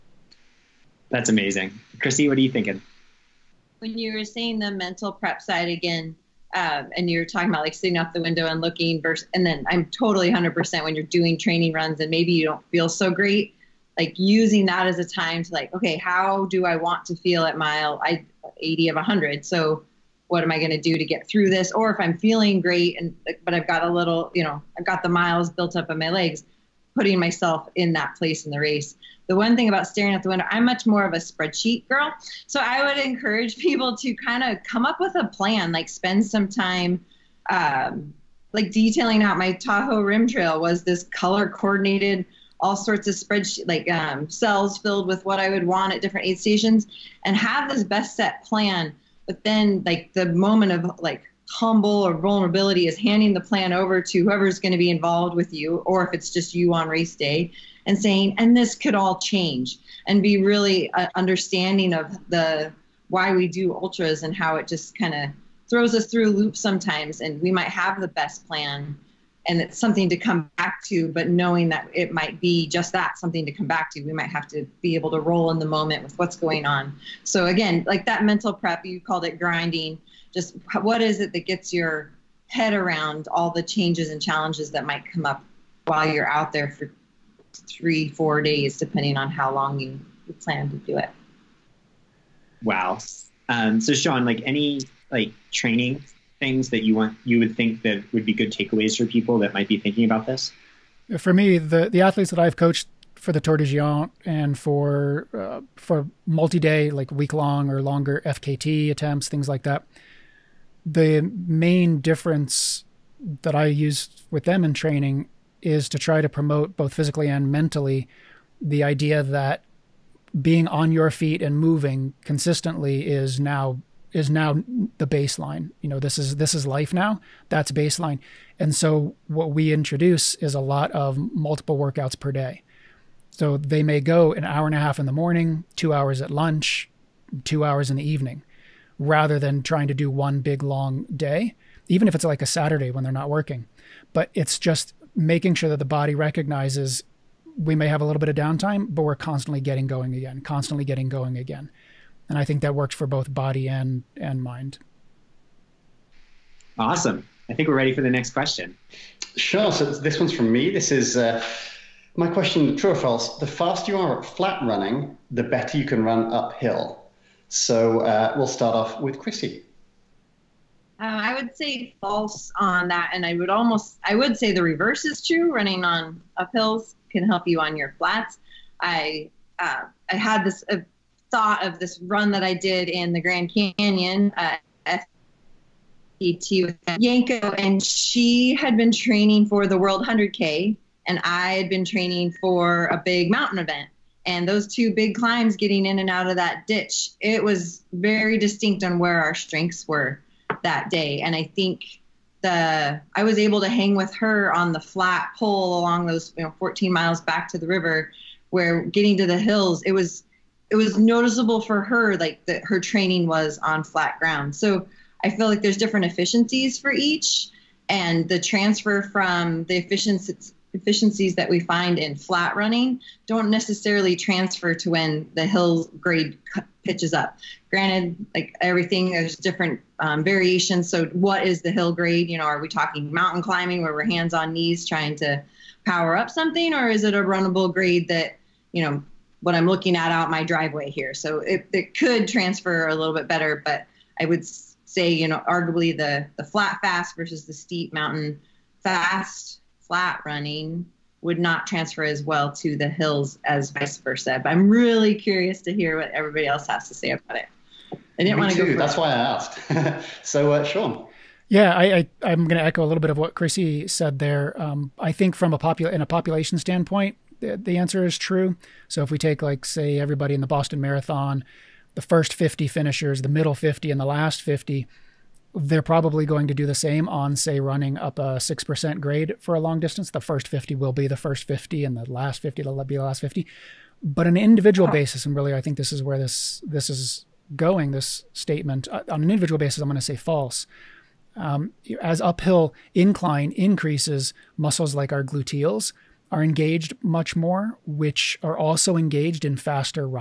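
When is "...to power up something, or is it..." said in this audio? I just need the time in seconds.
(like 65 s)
235 s.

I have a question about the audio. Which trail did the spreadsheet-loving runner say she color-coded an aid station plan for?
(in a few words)
Tahoe Rim Trail.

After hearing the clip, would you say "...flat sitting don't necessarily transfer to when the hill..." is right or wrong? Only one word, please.
wrong.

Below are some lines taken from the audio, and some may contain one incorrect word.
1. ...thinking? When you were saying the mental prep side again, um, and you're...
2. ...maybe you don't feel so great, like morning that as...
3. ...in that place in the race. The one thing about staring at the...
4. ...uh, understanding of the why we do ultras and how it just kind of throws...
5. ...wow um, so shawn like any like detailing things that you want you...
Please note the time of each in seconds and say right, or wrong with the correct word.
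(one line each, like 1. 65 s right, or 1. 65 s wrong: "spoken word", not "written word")
1. 2 s right
2. 12 s wrong: "using", not "morning"
3. 27 s right
4. 60 s right
5. 92 s wrong: "training", not "detailing".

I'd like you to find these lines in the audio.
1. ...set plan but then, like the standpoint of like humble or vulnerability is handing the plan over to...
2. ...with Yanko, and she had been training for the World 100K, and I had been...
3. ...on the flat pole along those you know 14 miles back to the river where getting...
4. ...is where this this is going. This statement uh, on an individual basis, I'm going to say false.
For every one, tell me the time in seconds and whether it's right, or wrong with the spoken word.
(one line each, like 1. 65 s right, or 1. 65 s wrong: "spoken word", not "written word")
1. 48 s wrong: "moment", not "standpoint"
2. 186 s right
3. 204 s right
4. 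285 s right.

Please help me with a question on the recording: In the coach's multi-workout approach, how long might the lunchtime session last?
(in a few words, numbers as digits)
2 hours.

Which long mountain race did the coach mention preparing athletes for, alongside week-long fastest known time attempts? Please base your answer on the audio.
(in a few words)
Tor des Géants.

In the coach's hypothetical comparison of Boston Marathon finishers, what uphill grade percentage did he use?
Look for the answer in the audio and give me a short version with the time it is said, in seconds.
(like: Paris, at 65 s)
6%, at 278 s.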